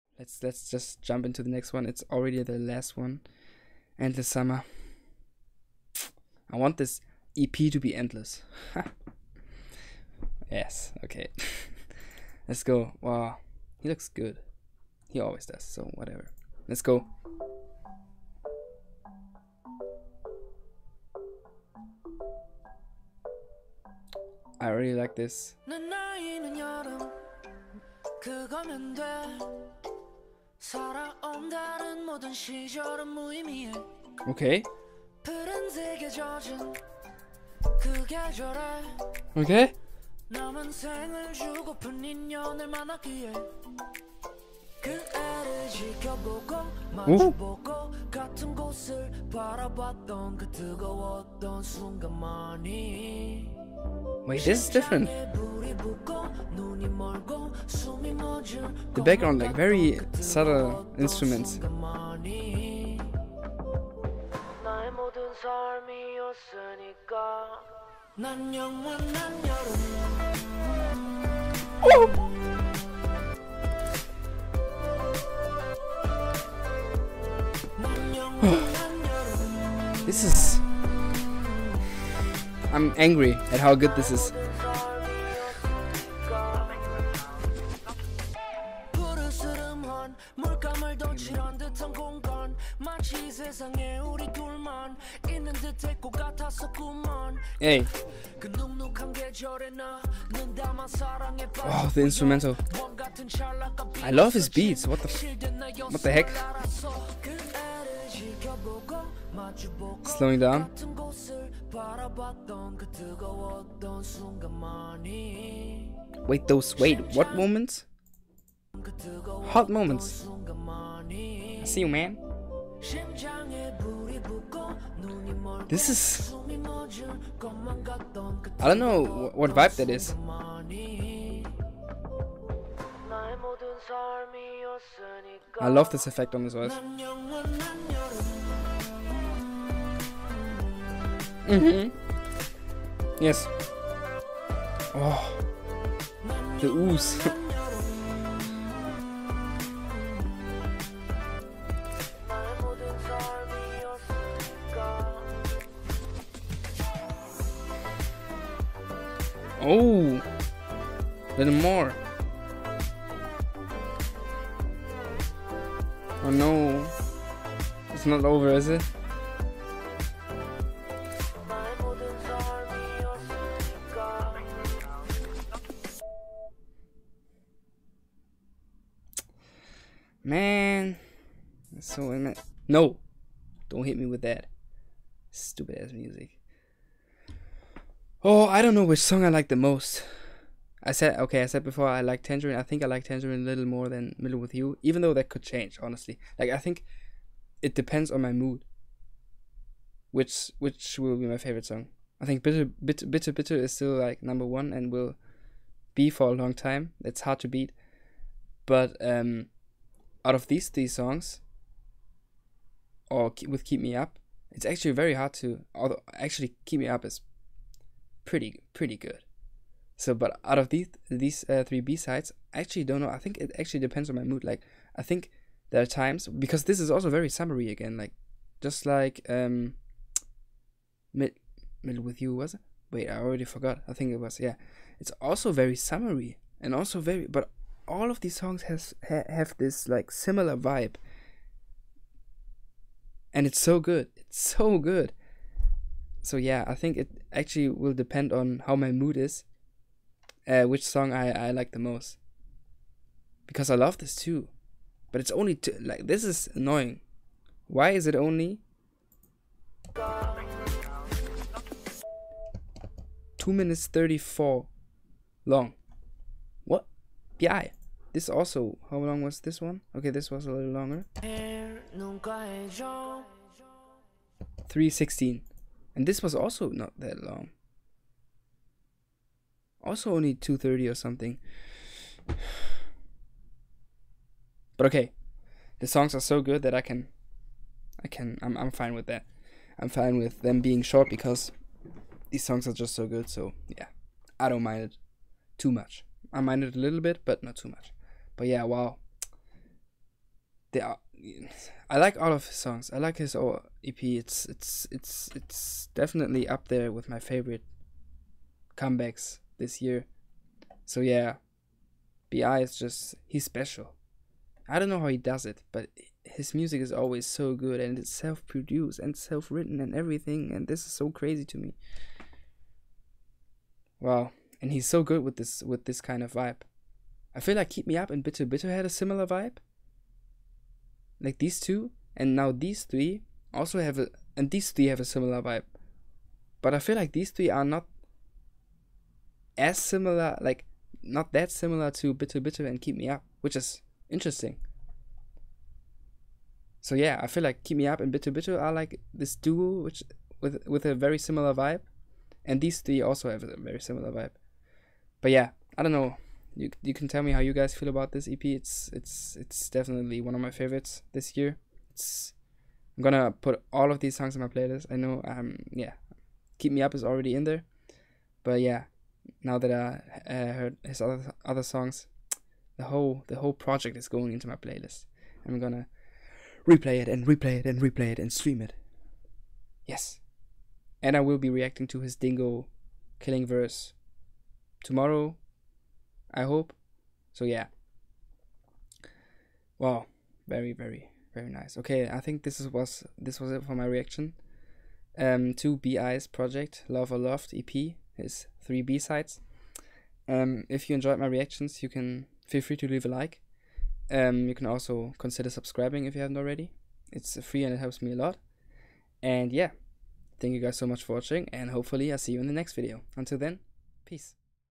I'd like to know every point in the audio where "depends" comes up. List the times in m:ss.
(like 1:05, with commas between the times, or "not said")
3:17, 3:43, 4:07.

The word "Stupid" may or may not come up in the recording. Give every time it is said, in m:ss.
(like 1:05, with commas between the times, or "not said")
3:05.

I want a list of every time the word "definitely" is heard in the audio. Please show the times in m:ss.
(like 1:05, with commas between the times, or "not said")
5:05, 5:59.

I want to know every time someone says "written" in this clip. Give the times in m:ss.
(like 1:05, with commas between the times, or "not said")
5:19.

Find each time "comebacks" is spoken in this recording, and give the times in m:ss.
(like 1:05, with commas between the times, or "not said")
5:08.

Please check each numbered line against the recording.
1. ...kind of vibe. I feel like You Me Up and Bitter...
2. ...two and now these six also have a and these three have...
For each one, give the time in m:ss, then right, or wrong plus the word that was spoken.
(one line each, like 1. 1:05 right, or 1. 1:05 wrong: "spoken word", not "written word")
1. 5:26 wrong: "Keep", not "You"
2. 5:31 wrong: "three", not "six".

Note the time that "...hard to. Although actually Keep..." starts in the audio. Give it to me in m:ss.
3:35.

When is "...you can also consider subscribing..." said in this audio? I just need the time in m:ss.
6:44.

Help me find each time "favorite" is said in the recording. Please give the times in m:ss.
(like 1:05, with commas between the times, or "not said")
3:21, 5:07, 6:00.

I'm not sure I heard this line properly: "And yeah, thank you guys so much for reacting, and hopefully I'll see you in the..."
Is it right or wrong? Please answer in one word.
wrong.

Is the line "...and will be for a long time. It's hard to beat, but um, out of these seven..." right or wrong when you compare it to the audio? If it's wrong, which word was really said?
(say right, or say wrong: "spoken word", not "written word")
wrong: "three", not "seven".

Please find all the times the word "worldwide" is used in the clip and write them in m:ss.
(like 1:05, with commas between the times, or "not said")
not said.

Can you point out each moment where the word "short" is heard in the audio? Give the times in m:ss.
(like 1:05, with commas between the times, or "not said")
4:50.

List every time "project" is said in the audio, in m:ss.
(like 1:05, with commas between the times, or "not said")
6:13, 6:36.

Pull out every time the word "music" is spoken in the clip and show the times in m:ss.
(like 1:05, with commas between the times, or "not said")
3:05, 5:16.